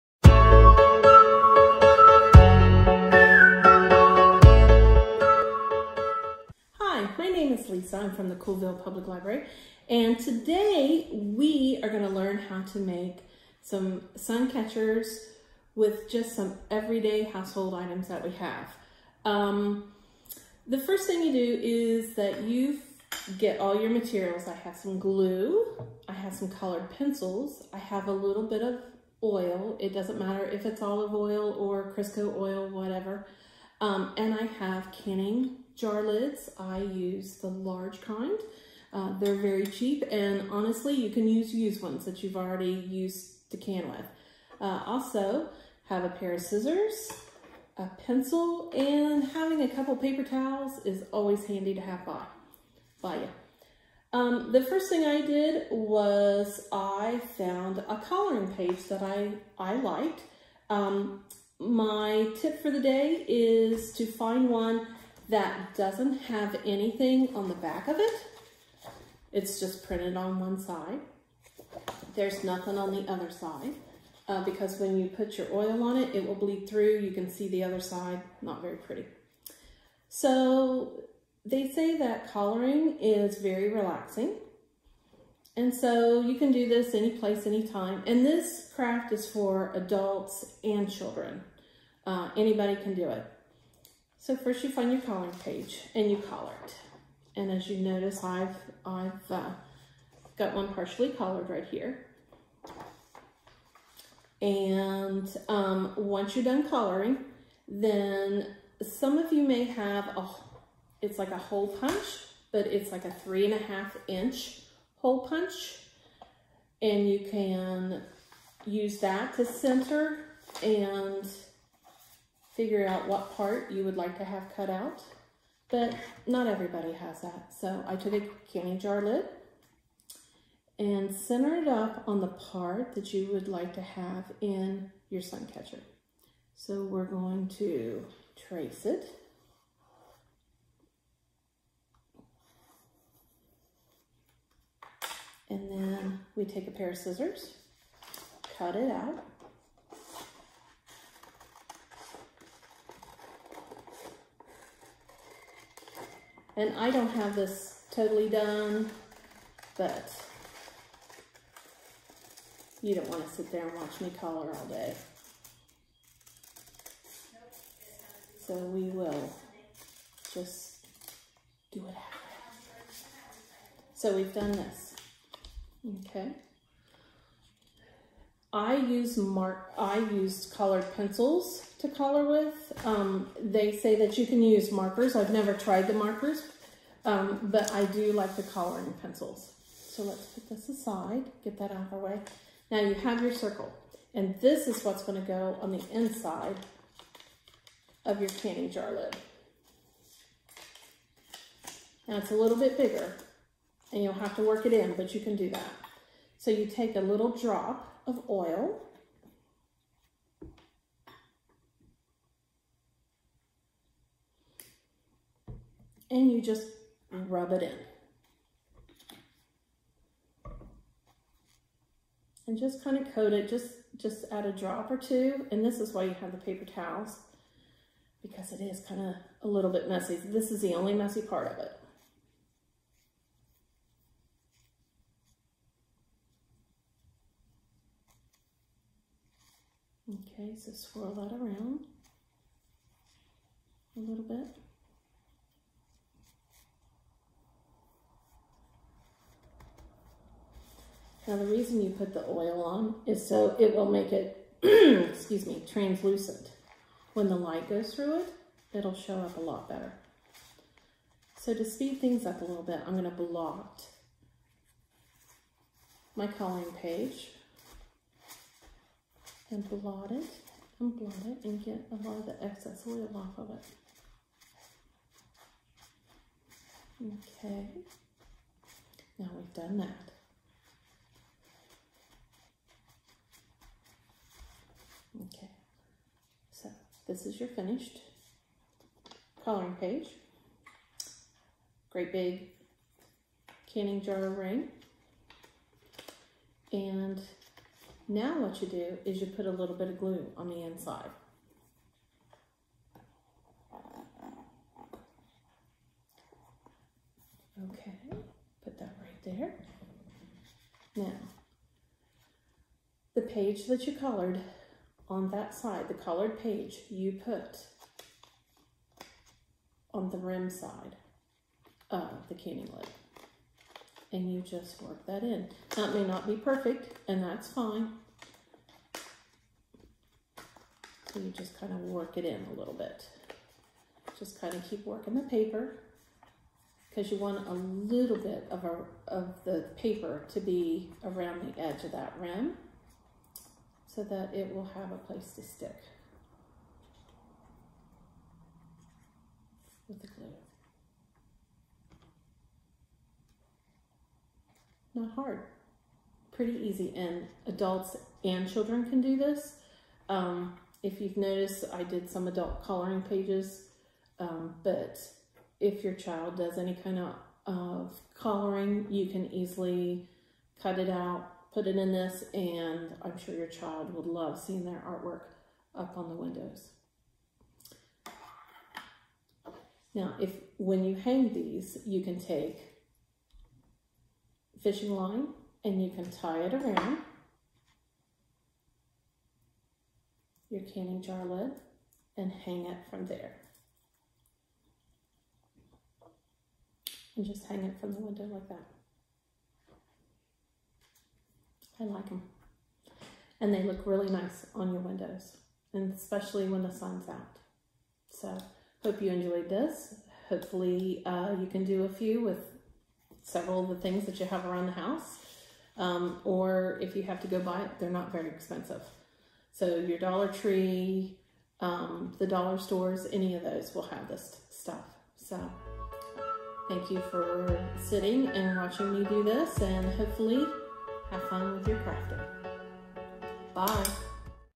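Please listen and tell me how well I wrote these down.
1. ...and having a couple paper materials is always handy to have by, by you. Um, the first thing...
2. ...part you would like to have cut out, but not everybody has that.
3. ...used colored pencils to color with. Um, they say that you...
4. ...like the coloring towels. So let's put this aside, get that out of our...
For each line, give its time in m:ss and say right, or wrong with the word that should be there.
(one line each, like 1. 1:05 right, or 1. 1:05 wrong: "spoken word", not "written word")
1. 0:48 wrong: "towels", not "materials"
2. 2:03 right
3. 2:59 right
4. 3:08 wrong: "pencils", not "towels".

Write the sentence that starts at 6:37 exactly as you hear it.
And just hang it from the window like that.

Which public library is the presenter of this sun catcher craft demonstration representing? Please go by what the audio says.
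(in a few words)
Coolville Public Library.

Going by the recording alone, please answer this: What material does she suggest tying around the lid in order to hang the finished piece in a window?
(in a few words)
Fishing line.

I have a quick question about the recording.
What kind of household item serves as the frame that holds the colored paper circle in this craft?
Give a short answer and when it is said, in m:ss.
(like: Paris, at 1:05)
Canning jar lids, at 0:34.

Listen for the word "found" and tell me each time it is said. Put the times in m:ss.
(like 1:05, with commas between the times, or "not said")
0:57.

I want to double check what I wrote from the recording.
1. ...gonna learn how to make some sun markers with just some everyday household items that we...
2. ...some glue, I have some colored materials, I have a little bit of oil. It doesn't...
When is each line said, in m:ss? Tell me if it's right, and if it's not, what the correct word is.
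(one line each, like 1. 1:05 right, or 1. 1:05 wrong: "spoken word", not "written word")
1. 0:11 wrong: "catchers", not "markers"
2. 0:24 wrong: "pencils", not "materials".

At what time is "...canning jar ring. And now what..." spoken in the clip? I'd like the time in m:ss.
4:53.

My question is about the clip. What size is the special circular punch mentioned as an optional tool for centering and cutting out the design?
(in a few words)
3.5 inch.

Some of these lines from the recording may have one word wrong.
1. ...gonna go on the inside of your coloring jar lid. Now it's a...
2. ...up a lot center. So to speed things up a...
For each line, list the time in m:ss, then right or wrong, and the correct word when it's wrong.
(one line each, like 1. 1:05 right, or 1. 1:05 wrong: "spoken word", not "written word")
1. 3:15 wrong: "canning", not "coloring"
2. 4:19 wrong: "better", not "center".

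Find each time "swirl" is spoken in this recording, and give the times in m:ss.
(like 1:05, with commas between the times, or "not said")
4:00.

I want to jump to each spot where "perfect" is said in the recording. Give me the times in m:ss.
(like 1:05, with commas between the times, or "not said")
5:26.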